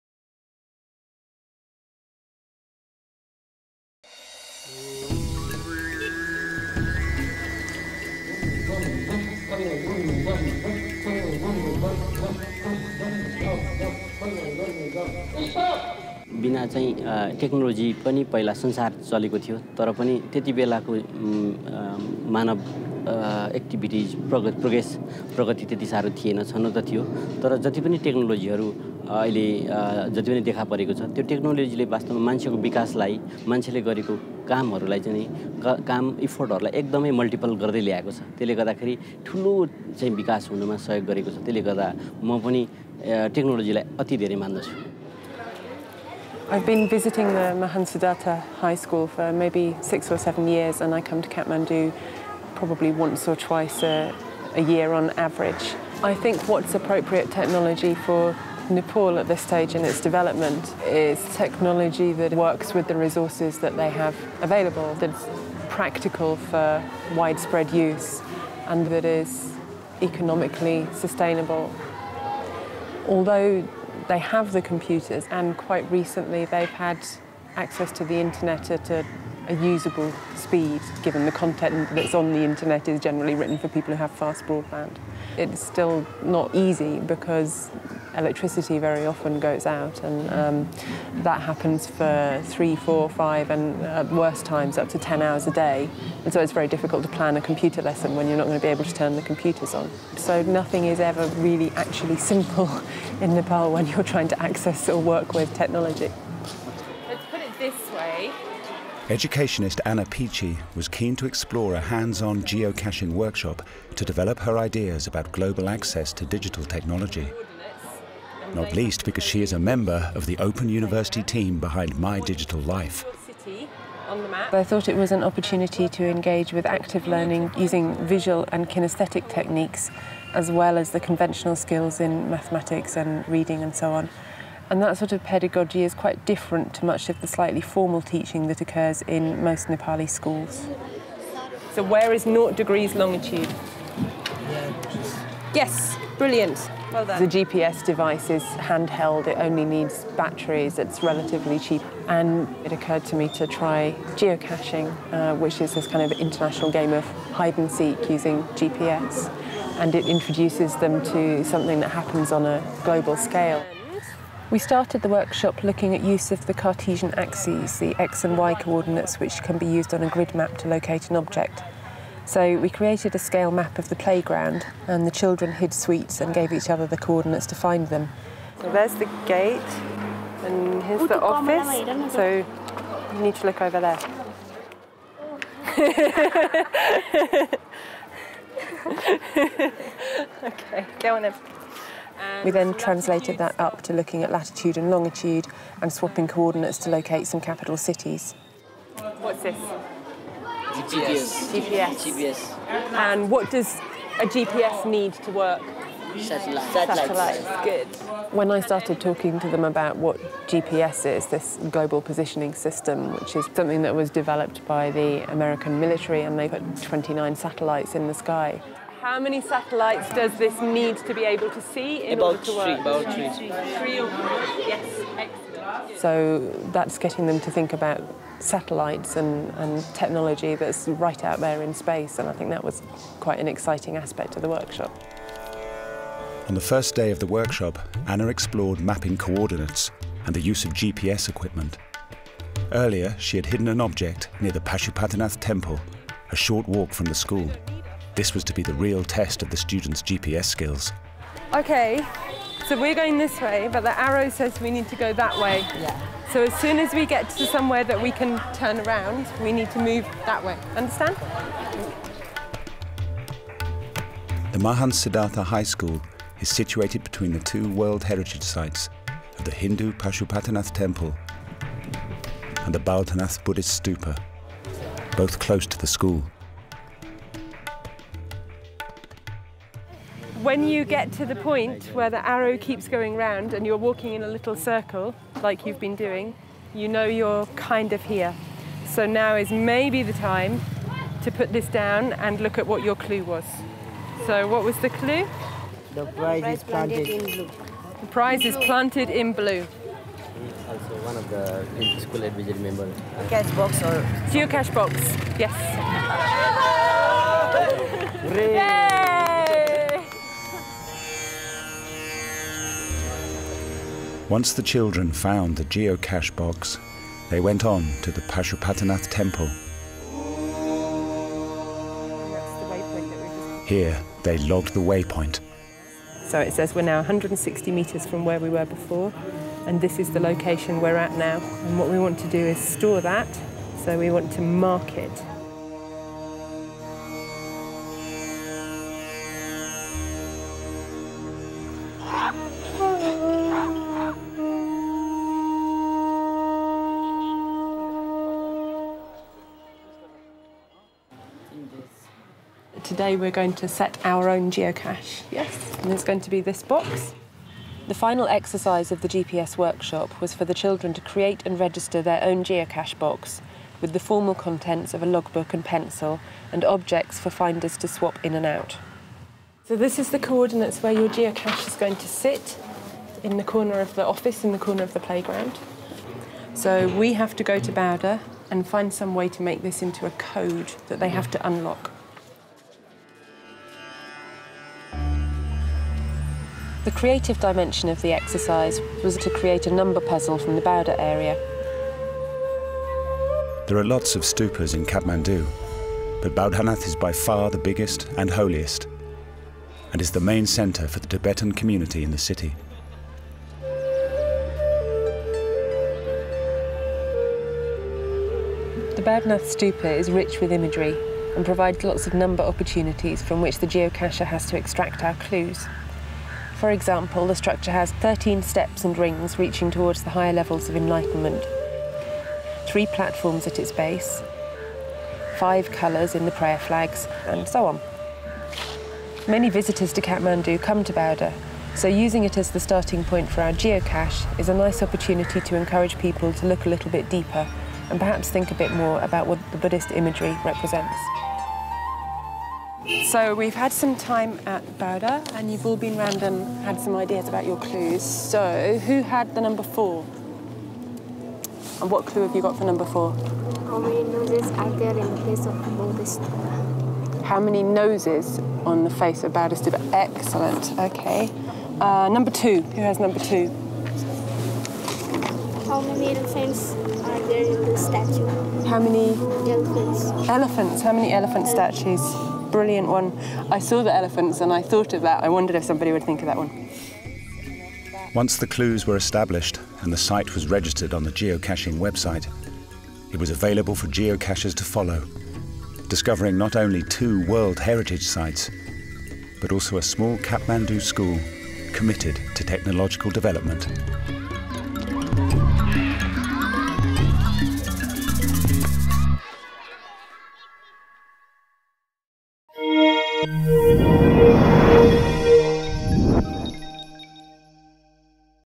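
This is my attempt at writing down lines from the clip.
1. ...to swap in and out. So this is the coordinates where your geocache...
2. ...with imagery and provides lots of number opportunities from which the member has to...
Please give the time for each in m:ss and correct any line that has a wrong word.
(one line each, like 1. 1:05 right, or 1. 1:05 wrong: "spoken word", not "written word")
1. 6:07 right
2. 6:50 wrong: "geocacher", not "member".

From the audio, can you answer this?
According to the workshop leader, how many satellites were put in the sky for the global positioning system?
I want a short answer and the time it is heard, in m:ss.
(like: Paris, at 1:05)
29, at 3:36.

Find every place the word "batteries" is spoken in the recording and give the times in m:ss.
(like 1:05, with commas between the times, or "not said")
2:30.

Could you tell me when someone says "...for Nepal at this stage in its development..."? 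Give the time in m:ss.
0:57.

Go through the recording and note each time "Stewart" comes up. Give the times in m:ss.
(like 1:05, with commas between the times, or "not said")
not said.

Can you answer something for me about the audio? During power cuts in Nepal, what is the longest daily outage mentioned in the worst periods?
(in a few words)
10 hours.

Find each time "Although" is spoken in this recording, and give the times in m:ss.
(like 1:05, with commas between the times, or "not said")
1:13.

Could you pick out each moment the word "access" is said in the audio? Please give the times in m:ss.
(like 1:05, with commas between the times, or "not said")
1:17, 1:44, 1:55.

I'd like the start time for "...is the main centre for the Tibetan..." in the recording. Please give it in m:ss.
6:40.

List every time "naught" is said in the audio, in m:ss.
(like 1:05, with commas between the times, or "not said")
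2:22.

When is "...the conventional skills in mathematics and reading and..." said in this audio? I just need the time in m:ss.
2:10.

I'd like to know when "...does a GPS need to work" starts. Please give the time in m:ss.
3:23.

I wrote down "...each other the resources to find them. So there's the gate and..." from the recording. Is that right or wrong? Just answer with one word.
wrong.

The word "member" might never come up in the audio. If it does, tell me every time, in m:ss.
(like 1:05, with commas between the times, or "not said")
1:59, 5:02.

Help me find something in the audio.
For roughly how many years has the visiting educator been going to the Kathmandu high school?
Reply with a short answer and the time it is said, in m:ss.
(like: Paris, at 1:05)
6 or 7, at 0:49.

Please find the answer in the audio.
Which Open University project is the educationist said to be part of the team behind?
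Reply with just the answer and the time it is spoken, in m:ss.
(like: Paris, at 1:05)
My Digital Life, at 2:01.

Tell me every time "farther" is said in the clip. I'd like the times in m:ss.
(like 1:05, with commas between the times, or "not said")
not said.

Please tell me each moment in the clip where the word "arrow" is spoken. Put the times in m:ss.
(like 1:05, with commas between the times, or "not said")
4:13, 4:42.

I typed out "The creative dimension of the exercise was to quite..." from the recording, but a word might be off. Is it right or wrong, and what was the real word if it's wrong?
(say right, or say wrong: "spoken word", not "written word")
wrong: "create", not "quite".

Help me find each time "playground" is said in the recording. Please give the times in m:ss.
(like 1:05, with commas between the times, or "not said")
2:53, 6:14.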